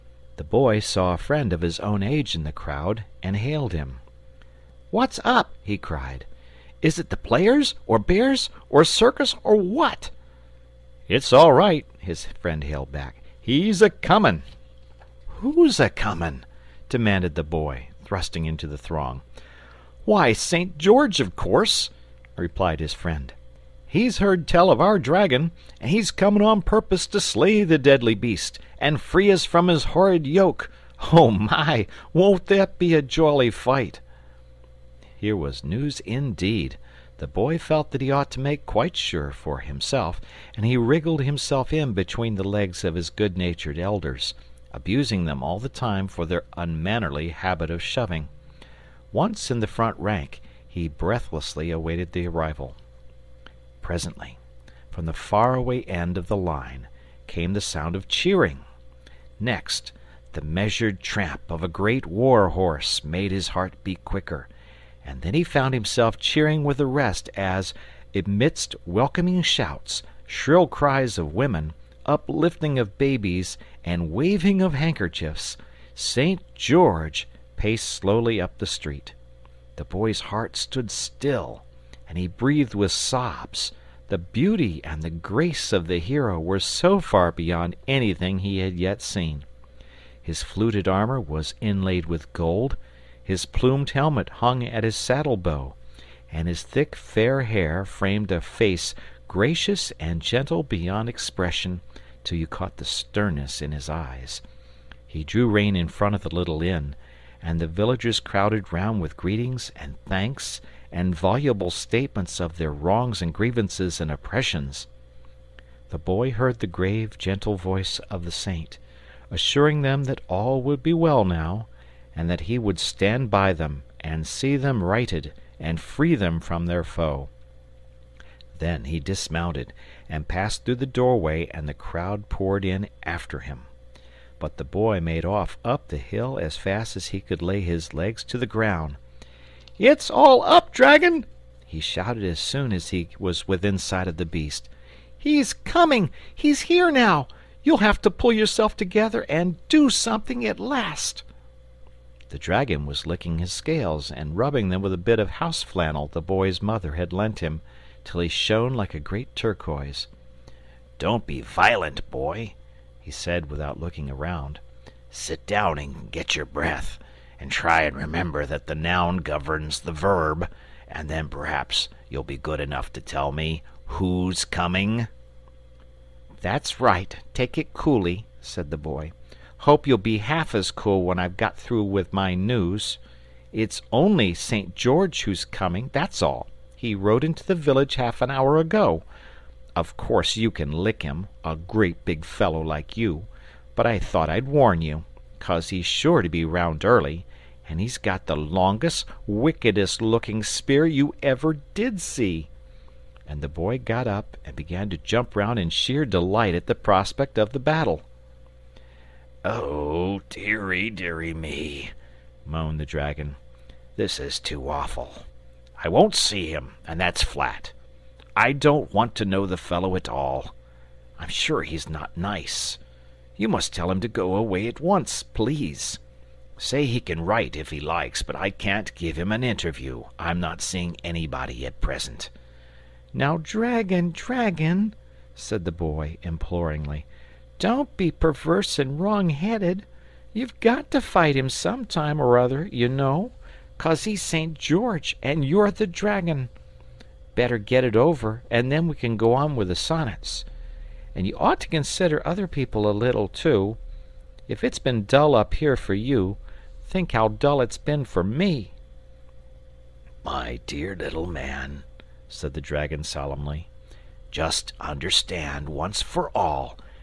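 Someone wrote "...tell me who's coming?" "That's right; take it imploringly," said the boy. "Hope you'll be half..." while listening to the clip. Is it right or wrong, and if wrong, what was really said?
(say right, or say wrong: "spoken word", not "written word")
wrong: "coolly", not "imploringly".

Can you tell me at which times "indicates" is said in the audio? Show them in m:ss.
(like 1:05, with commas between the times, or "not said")
not said.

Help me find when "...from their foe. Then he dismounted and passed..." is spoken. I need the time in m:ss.
2:06.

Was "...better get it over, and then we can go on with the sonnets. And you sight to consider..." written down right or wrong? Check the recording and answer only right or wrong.
wrong.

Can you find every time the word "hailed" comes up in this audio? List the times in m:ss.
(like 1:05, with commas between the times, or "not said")
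0:03, 0:12.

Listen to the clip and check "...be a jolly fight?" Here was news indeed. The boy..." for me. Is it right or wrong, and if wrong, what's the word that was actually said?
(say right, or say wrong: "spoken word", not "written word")
right.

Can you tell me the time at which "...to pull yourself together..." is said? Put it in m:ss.
2:28.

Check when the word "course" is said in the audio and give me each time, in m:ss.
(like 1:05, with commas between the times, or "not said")
0:21, 3:09.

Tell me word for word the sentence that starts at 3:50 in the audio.
I'm not seeing anybody at present.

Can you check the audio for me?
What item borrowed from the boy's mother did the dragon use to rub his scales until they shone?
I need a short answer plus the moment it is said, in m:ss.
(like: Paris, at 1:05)
house flannel, at 2:35.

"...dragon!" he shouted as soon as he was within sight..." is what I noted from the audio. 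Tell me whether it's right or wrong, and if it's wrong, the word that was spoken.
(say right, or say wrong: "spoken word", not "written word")
right.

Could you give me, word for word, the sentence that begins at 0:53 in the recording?
Presently, from the faraway end of the line, came the sound of cheering.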